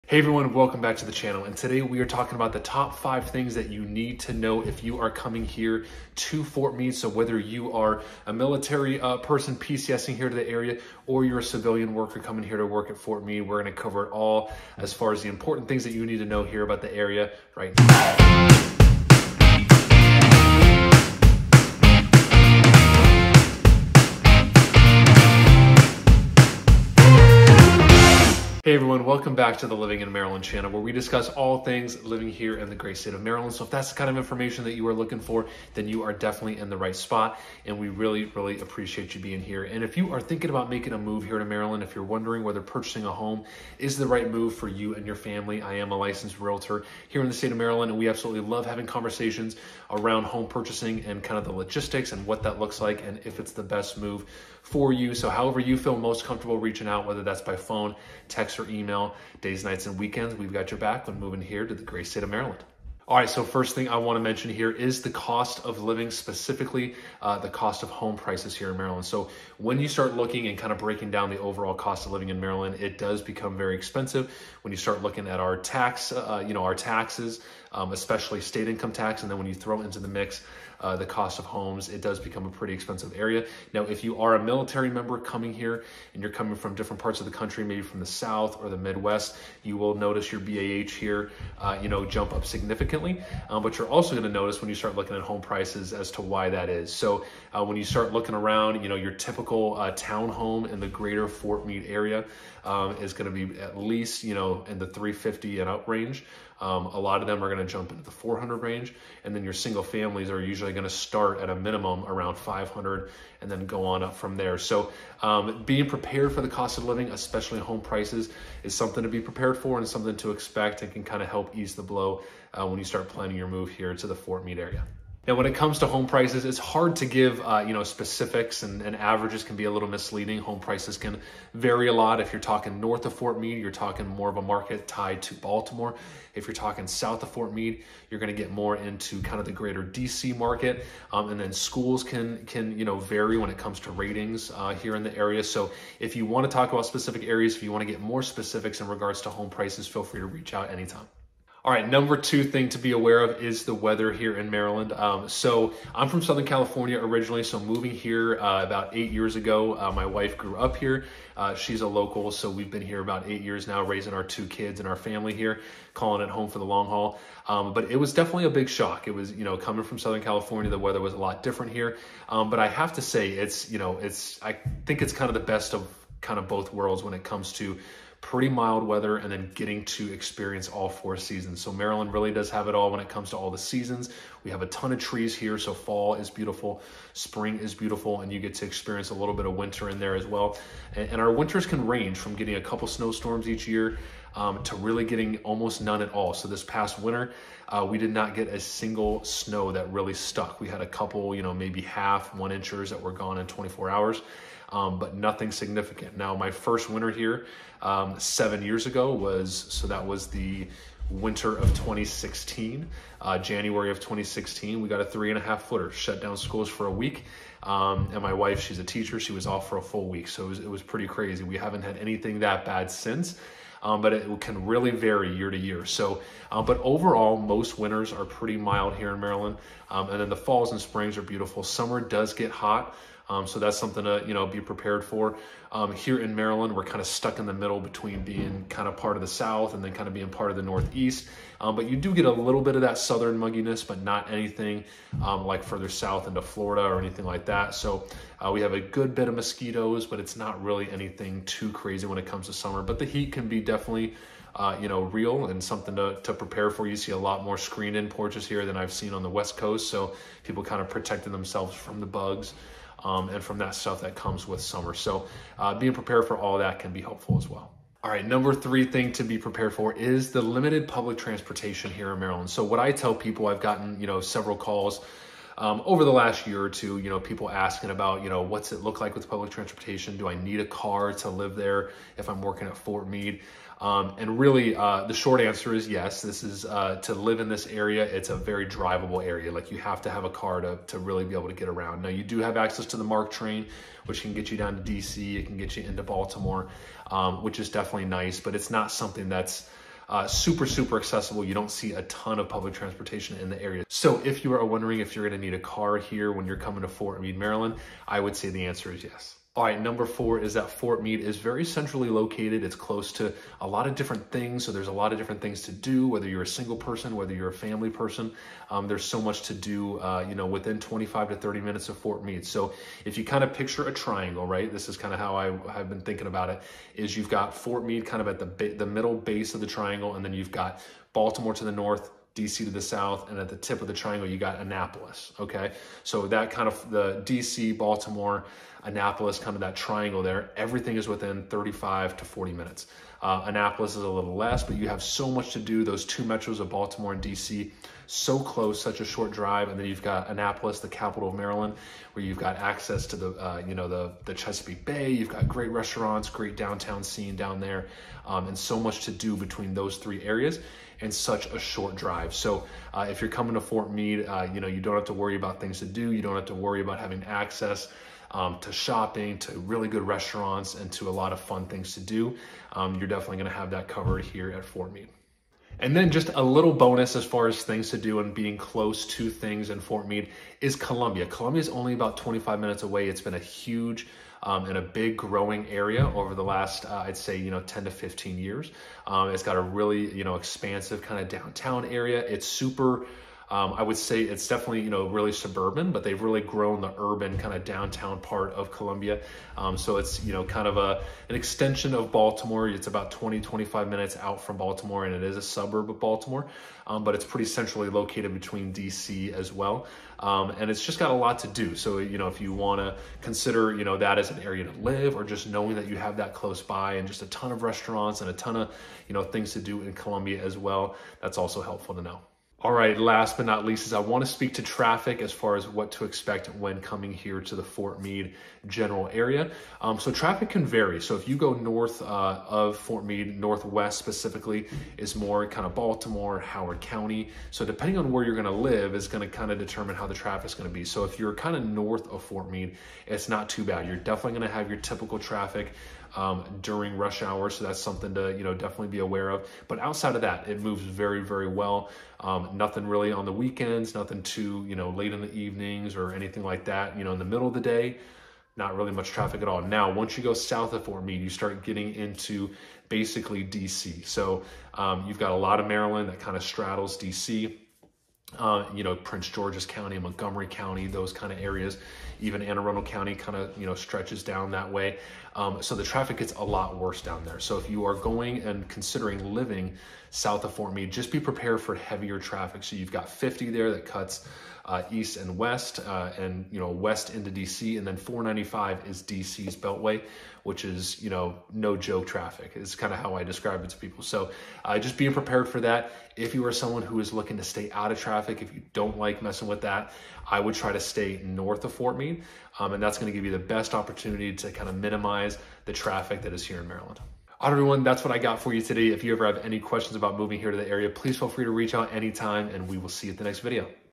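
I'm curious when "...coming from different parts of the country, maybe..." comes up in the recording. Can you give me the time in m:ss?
1:26.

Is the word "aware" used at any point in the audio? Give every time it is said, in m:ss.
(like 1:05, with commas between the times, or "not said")
2:32, 7:28.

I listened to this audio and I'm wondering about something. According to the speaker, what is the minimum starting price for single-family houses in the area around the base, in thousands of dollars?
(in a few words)
500.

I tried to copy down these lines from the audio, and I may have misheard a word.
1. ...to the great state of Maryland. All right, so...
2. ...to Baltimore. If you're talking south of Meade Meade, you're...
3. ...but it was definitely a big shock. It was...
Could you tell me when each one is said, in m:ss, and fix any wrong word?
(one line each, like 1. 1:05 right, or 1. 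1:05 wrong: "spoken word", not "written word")
1. 1:01 right
2. 2:15 wrong: "Fort", not "Meade"
3. 2:47 right.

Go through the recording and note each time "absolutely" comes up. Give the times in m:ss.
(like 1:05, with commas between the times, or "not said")
0:48.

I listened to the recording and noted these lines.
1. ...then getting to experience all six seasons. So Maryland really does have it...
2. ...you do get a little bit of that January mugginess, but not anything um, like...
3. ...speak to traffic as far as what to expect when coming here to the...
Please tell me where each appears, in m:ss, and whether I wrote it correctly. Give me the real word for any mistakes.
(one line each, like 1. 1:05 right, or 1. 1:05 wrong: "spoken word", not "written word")
1. 2:59 wrong: "four", not "six"
2. 4:01 wrong: "Southern", not "January"
3. 7:04 right.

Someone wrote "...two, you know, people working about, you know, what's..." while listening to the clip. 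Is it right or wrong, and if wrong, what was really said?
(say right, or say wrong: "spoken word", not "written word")
wrong: "asking", not "working".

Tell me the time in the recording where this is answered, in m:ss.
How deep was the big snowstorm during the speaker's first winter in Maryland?
3:35.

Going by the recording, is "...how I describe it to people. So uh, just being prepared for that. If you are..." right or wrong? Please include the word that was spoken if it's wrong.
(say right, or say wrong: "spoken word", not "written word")
right.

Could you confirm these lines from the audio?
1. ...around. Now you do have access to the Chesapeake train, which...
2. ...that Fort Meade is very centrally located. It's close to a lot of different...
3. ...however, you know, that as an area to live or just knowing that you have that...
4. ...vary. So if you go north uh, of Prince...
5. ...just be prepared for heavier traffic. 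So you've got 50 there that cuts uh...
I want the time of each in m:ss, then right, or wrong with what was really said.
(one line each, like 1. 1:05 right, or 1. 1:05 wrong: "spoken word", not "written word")
1. 4:51 wrong: "MARC", not "Chesapeake"
2. 5:10 right
3. 6:53 wrong: "consider", not "however"
4. 7:10 wrong: "Fort", not "Prince"
5. 8:00 right.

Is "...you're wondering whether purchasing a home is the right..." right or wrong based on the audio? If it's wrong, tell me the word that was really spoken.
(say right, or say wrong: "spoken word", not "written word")
right.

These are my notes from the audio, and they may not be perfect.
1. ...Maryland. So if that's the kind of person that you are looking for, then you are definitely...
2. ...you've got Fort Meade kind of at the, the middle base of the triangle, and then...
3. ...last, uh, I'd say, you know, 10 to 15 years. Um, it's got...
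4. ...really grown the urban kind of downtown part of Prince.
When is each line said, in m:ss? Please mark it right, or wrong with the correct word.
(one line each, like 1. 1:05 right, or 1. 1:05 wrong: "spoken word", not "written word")
1. 0:33 wrong: "information", not "person"
2. 5:27 right
3. 6:26 right
4. 6:36 wrong: "Columbia", not "Prince".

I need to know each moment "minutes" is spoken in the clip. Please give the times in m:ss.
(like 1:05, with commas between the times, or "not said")
5:21, 5:42, 6:22, 6:43.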